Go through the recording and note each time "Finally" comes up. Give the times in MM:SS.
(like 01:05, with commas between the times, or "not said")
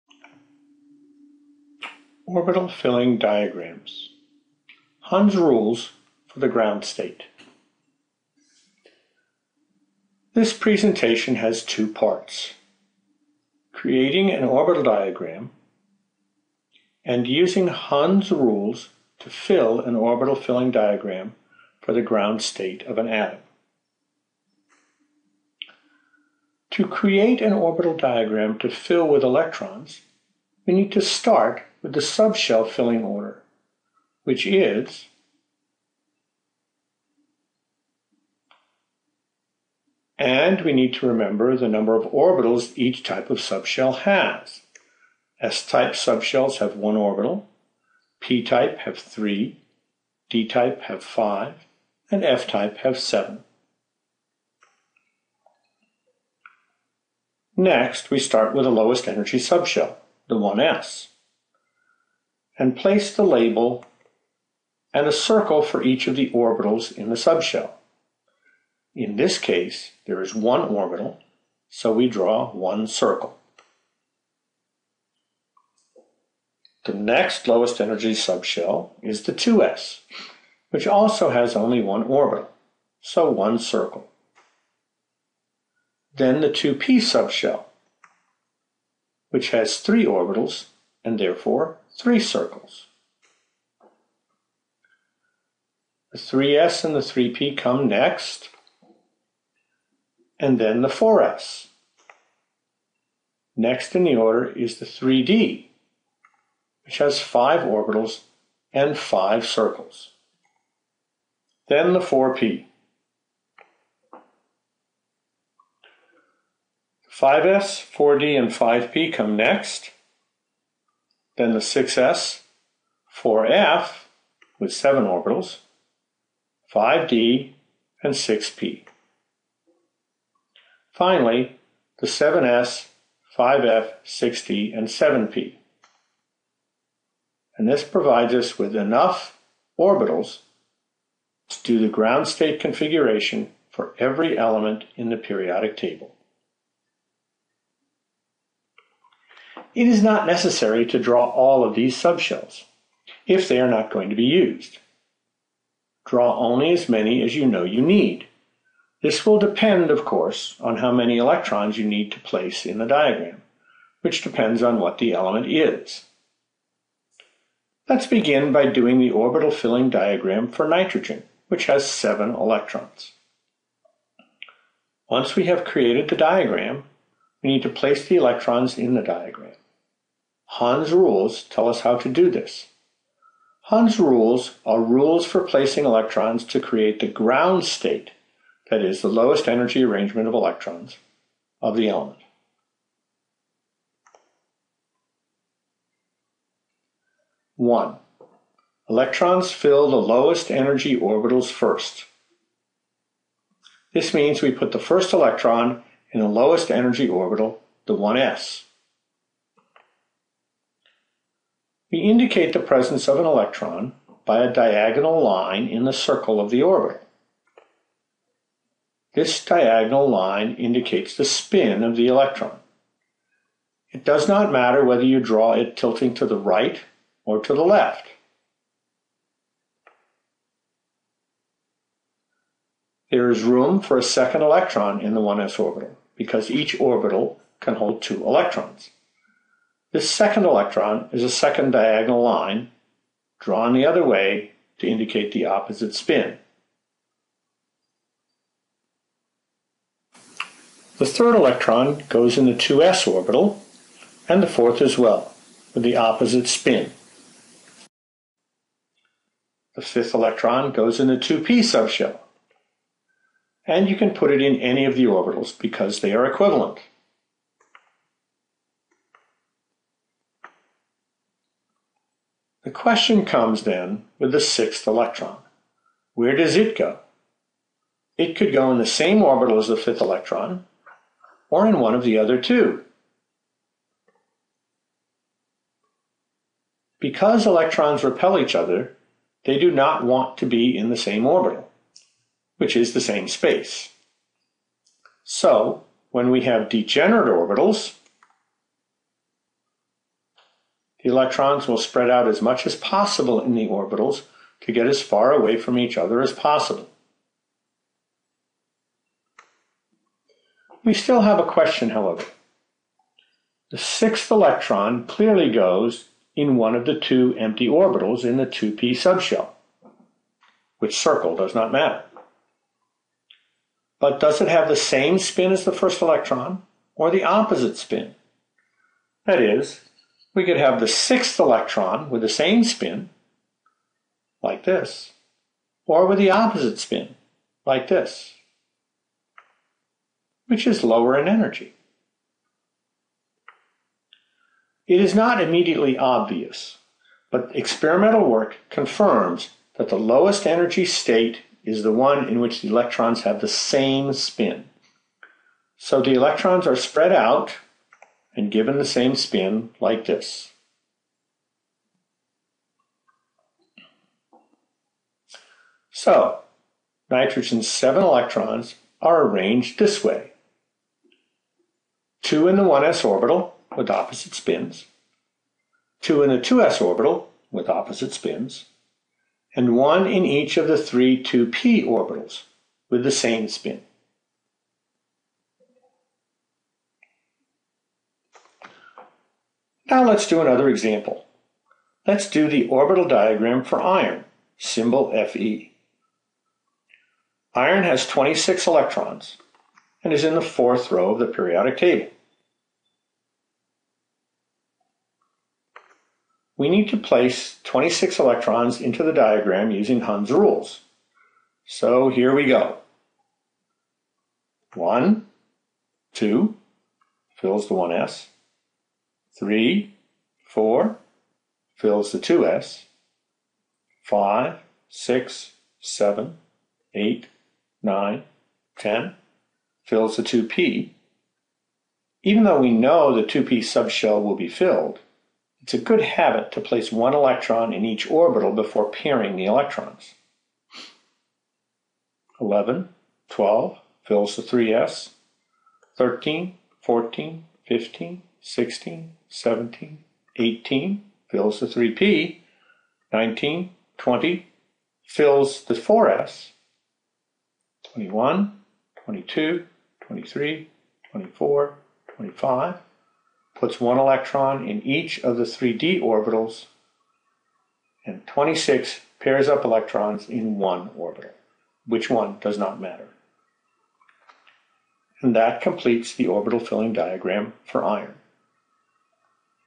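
02:10.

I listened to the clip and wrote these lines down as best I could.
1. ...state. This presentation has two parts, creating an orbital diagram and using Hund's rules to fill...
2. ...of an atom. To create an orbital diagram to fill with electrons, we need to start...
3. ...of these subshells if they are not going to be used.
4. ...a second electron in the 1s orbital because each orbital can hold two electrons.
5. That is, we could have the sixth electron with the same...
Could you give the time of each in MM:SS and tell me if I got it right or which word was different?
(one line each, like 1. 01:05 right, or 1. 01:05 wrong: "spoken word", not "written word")
1. 00:06 right
2. 00:22 right
3. 02:31 right
4. 03:53 right
5. 05:29 right.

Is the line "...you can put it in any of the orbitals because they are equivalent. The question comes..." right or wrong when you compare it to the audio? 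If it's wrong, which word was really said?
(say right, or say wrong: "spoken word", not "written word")
right.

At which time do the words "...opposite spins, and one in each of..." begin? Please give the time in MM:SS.
06:17.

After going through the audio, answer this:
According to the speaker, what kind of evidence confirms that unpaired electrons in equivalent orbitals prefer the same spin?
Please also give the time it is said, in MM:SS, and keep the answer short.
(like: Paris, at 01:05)
experimental work, at 05:47.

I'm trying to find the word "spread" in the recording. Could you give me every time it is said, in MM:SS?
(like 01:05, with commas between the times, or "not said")
05:01, 05:56.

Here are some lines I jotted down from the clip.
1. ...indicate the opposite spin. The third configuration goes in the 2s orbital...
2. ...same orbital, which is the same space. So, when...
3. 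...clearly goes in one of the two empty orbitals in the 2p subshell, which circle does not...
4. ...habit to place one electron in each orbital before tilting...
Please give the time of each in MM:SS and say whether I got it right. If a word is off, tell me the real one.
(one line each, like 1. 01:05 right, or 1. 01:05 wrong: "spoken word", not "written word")
1. 04:04 wrong: "electron", not "configuration"
2. 04:50 right
3. 05:15 right
4. 07:16 wrong: "pairing", not "tilting".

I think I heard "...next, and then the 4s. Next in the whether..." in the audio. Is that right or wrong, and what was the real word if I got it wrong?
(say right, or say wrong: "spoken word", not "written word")
wrong: "order", not "whether".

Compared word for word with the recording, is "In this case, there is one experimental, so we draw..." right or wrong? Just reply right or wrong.
wrong.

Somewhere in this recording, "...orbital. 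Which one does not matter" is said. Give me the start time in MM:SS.
07:50.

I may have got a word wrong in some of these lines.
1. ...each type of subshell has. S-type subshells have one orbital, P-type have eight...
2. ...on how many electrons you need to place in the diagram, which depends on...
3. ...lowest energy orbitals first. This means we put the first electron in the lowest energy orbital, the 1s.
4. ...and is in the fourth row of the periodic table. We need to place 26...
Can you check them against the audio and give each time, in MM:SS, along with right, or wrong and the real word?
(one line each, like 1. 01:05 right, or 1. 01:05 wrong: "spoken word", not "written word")
1. 00:42 wrong: "three", not "eight"
2. 02:40 right
3. 03:19 right
4. 06:40 right.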